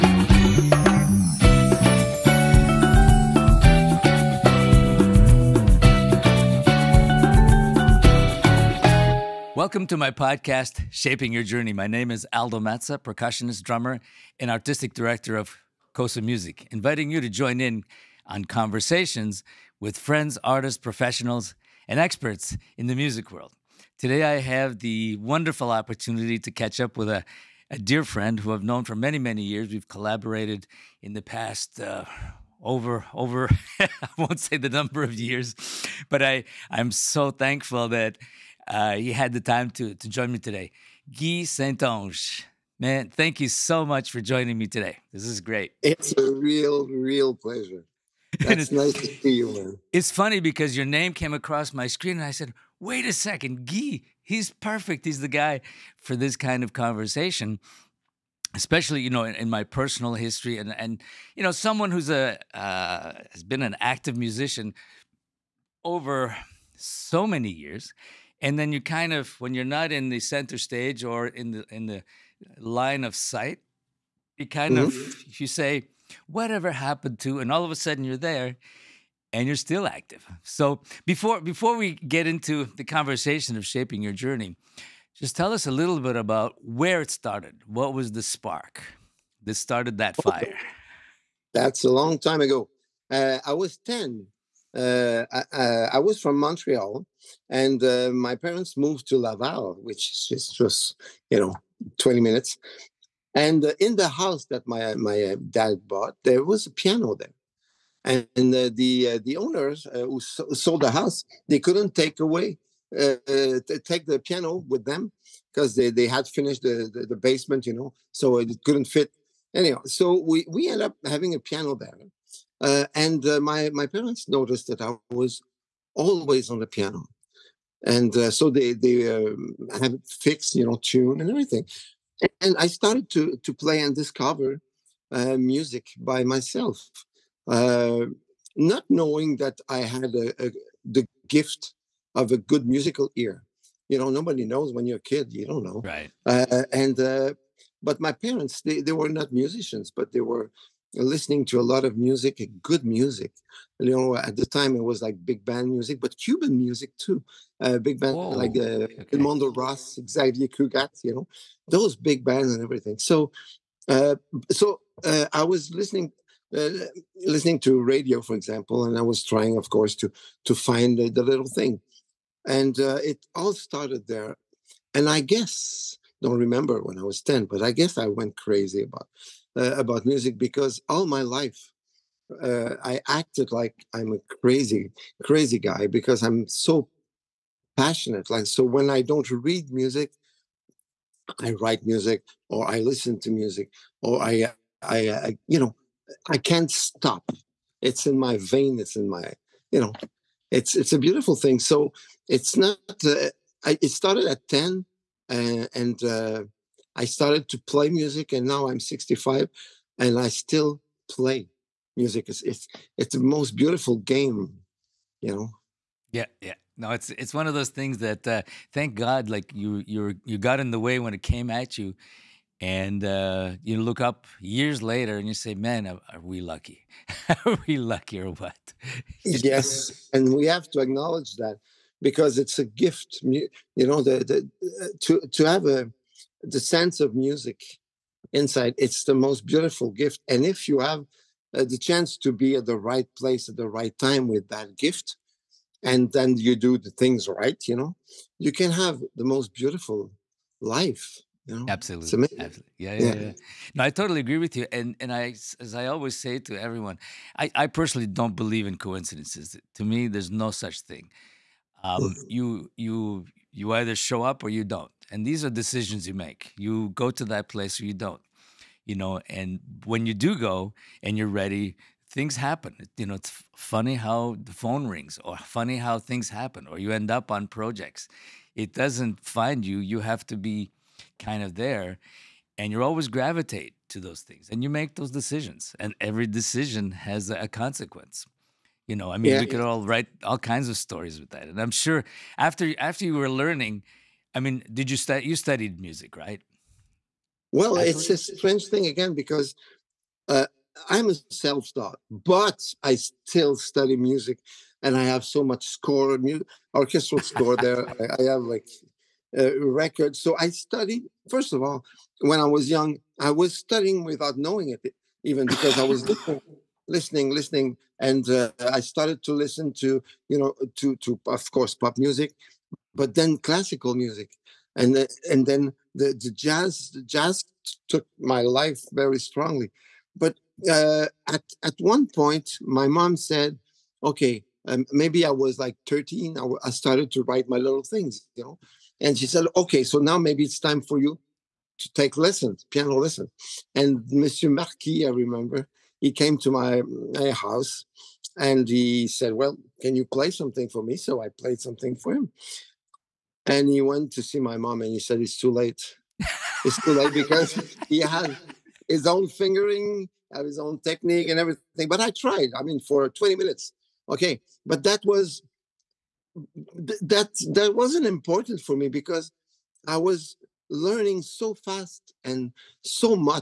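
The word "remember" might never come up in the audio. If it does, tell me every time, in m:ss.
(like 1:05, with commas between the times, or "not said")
2:56, 5:45.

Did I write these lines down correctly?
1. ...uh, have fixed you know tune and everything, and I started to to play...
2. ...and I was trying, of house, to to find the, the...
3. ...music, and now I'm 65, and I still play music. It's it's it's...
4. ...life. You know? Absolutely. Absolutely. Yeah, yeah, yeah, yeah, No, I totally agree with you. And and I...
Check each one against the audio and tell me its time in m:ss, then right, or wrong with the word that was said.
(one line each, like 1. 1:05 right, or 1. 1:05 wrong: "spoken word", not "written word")
1. 2:09 right
2. 2:48 wrong: "course", not "house"
3. 3:27 right
4. 4:10 right.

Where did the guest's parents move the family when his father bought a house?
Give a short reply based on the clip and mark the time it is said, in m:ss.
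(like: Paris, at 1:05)
Laval, at 1:39.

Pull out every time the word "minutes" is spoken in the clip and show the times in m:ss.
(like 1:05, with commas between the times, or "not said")
1:42, 6:03.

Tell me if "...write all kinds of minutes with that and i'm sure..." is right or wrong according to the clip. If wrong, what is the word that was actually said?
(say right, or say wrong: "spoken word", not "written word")
wrong: "stories", not "minutes".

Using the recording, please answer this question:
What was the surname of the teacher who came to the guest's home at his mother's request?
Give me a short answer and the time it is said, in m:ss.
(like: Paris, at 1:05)
Marquis, at 5:44.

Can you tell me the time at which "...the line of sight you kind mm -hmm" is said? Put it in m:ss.
1:11.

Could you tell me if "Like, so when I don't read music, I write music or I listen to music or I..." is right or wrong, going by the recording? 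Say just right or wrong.
right.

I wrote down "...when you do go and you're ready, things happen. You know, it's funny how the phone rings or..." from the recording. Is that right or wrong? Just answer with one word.
right.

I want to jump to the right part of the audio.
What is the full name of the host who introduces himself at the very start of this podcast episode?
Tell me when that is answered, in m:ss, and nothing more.
0:12.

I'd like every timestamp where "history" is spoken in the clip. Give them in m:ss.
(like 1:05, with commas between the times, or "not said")
1:00.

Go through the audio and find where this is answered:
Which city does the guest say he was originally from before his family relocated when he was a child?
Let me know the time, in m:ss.
1:36.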